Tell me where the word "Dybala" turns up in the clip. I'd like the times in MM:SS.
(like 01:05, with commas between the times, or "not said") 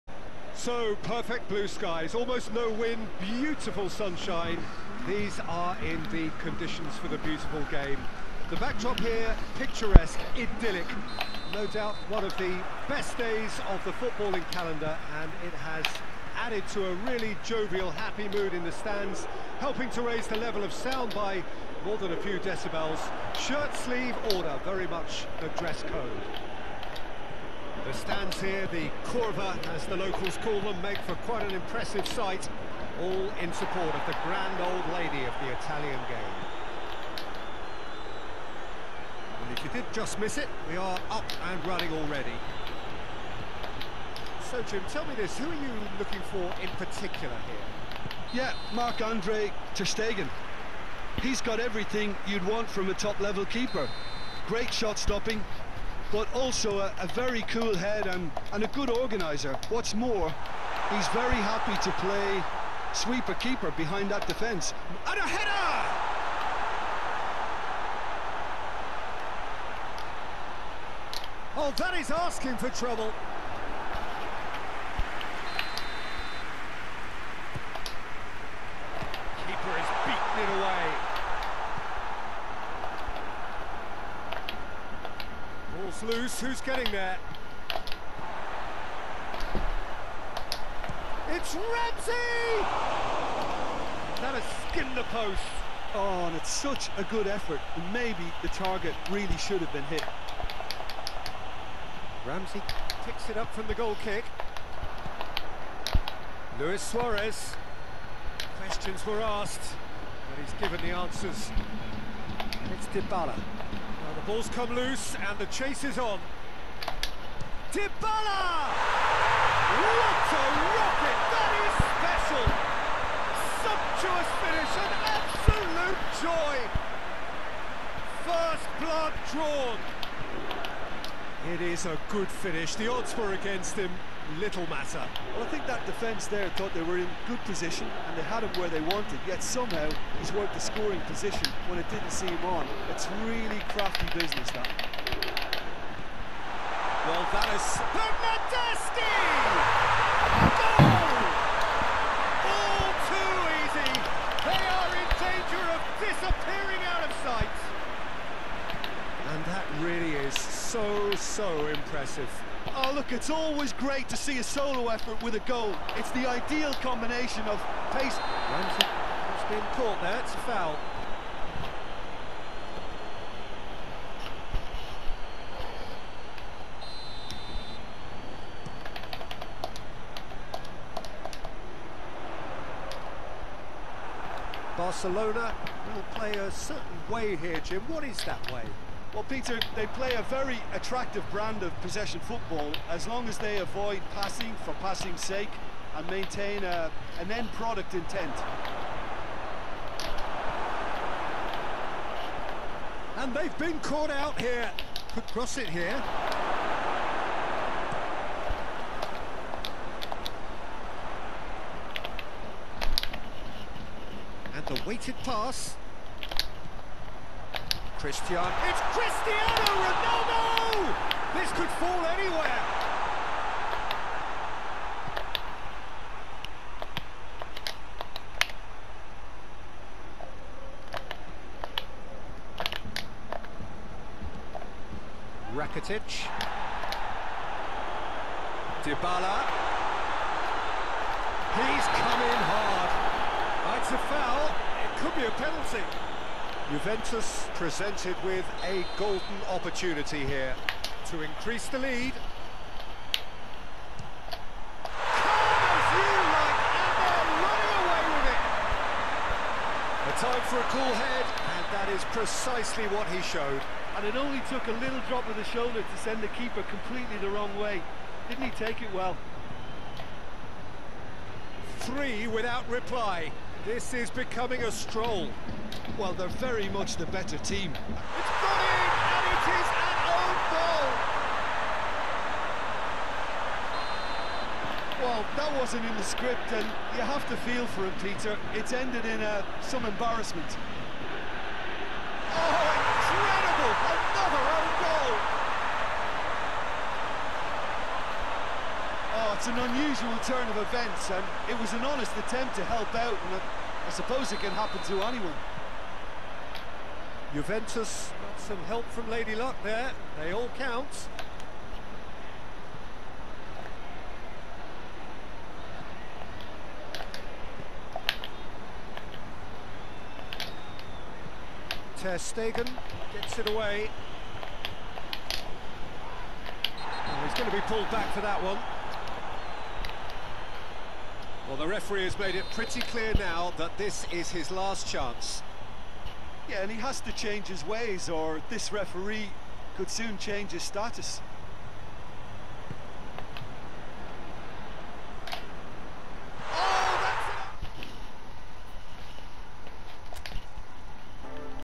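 01:52, 01:57, 03:58.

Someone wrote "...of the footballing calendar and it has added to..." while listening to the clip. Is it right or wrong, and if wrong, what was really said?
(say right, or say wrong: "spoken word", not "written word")
right.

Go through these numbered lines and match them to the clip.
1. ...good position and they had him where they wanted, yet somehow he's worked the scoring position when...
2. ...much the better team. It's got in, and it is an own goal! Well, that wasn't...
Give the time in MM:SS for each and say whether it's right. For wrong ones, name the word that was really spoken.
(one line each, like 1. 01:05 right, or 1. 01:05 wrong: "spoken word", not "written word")
1. 02:17 right
2. 04:36 right.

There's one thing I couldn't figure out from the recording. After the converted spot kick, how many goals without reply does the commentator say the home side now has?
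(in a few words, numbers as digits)
3.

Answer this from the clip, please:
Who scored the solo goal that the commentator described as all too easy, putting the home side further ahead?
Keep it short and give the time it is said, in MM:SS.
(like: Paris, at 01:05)
Bernardeschi, at 02:27.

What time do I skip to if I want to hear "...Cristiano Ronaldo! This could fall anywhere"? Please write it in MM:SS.
03:38.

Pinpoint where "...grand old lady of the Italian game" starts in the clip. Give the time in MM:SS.
00:34.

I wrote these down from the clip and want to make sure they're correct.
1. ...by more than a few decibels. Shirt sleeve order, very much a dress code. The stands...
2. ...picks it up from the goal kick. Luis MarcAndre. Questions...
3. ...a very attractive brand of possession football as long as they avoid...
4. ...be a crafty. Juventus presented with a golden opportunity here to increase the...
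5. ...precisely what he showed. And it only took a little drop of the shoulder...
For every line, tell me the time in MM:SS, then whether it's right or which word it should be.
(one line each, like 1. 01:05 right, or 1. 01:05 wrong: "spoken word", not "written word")
1. 00:21 right
2. 01:43 wrong: "Suarez", not "MarcAndre"
3. 03:10 right
4. 04:05 wrong: "penalty", not "crafty"
5. 04:22 right.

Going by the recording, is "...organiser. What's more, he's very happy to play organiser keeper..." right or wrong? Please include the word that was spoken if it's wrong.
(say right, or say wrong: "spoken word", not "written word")
wrong: "sweeper", not "organiser".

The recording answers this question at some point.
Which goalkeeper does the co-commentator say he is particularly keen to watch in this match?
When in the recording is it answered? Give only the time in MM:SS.
00:48.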